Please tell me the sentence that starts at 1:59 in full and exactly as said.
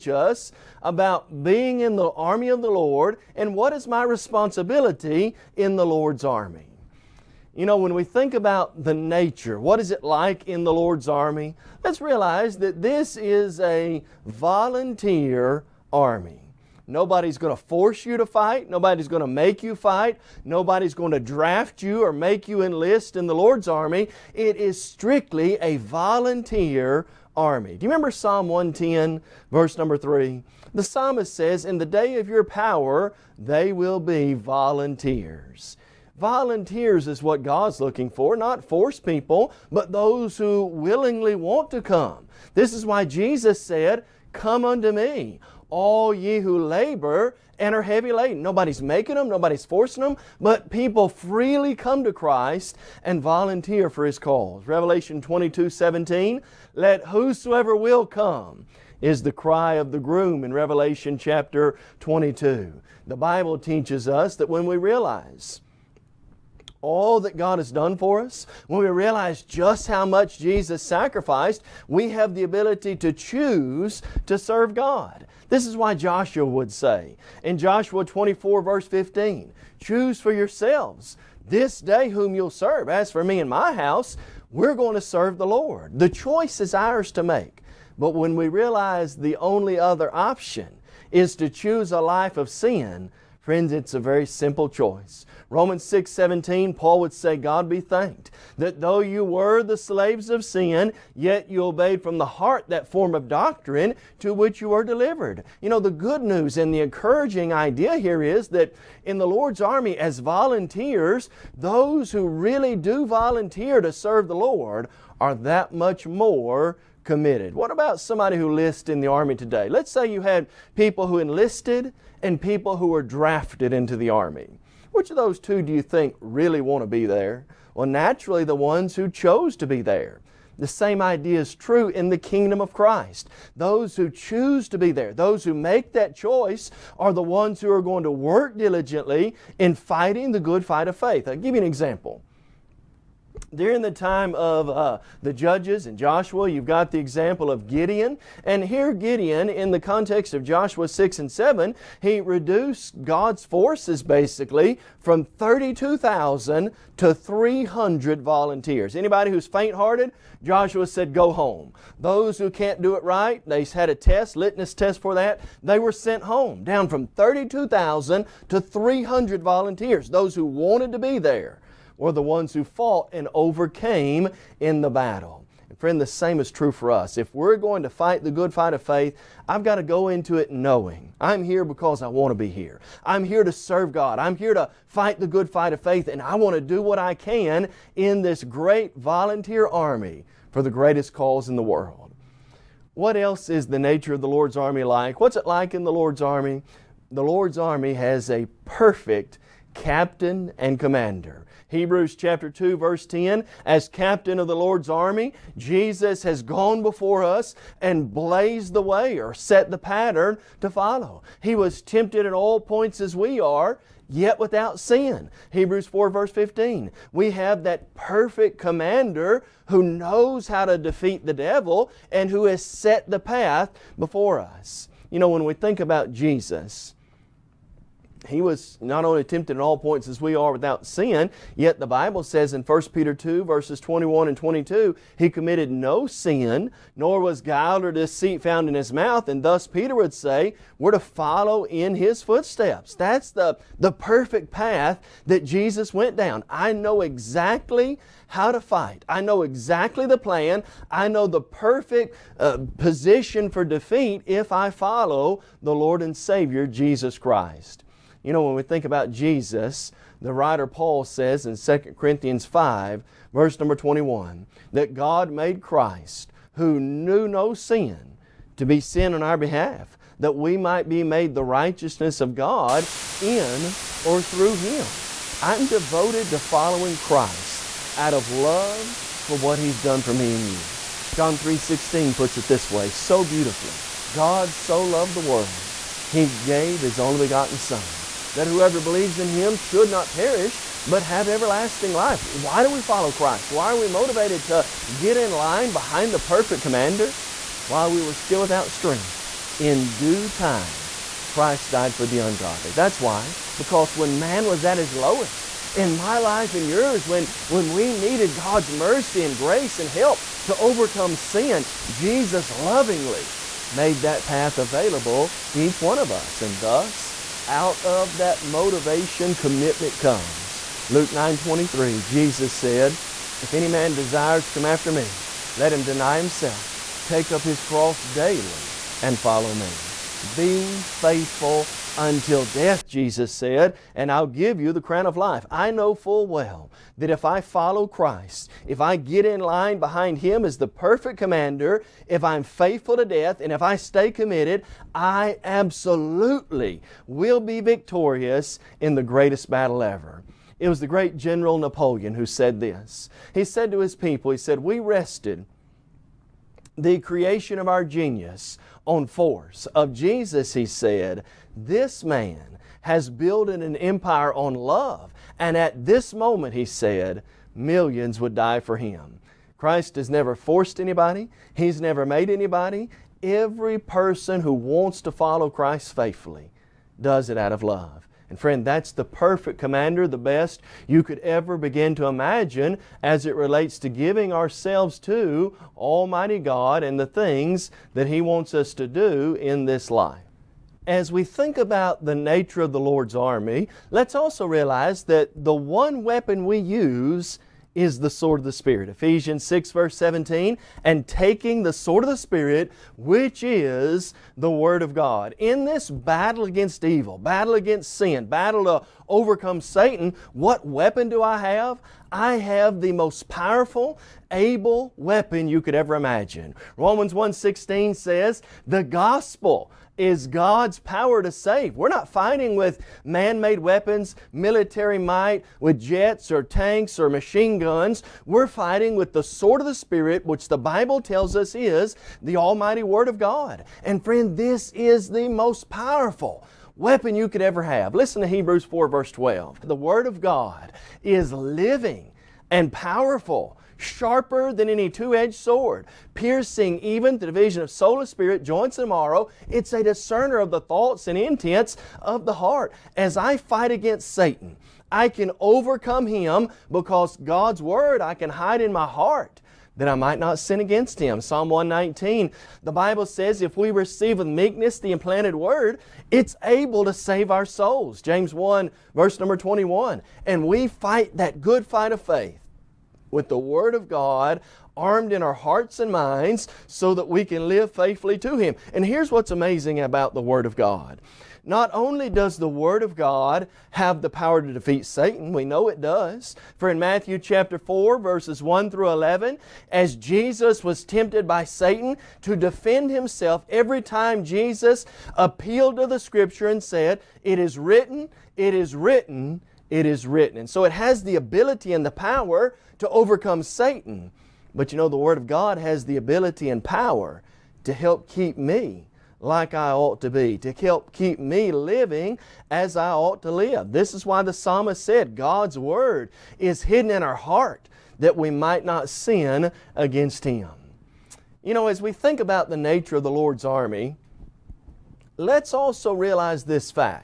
Let's say you had people who enlisted and people who were drafted into the army.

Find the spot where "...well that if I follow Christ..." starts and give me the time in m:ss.
5:36.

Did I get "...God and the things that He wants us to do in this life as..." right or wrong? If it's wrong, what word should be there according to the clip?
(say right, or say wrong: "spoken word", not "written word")
right.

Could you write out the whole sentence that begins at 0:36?
Volunteers is what God's looking for, not force people, but those who willingly want to come.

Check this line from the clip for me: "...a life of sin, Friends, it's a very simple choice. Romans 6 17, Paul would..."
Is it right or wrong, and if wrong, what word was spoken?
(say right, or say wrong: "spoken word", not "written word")
right.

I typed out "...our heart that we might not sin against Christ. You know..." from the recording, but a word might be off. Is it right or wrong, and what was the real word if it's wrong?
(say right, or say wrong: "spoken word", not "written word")
wrong: "Him", not "Christ".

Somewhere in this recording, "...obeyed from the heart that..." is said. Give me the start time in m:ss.
1:41.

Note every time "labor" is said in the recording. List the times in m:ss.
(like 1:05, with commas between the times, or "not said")
0:46.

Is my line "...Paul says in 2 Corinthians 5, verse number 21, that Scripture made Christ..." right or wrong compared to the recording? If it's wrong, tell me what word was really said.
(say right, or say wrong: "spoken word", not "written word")
wrong: "God", not "Scripture".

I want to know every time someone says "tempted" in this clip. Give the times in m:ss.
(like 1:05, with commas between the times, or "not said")
3:31, 3:49, 8:10.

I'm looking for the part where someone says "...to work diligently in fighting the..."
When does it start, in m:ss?
2:18.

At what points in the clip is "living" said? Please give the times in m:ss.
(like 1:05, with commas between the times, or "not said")
7:21, 8:31.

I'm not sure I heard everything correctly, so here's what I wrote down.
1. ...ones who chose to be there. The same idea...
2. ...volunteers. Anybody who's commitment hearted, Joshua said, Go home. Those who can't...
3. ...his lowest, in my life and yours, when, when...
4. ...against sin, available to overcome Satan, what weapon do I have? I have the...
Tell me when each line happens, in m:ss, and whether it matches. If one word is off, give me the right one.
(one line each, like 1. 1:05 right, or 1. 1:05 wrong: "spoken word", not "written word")
1. 2:08 right
2. 2:38 wrong: "faint", not "commitment"
3. 5:04 right
4. 6:47 wrong: "battle", not "available".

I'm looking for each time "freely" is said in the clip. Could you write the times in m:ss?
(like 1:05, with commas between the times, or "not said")
0:51.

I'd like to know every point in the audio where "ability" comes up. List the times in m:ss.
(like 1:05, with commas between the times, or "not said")
1:12, 8:21, 8:25.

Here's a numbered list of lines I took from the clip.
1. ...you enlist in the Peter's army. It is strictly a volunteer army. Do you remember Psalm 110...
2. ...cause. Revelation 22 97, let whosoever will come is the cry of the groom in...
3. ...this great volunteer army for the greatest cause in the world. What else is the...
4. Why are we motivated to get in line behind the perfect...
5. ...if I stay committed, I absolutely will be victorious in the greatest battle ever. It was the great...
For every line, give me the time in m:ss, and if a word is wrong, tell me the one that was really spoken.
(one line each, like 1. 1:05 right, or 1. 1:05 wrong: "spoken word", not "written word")
1. 0:22 wrong: "Lord", not "Peter"
2. 0:54 wrong: "17", not "97"
3. 3:08 right
4. 4:53 right
5. 5:43 right.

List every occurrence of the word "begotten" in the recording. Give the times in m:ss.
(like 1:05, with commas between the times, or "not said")
4:47.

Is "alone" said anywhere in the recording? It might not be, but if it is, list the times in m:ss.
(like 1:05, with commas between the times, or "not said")
not said.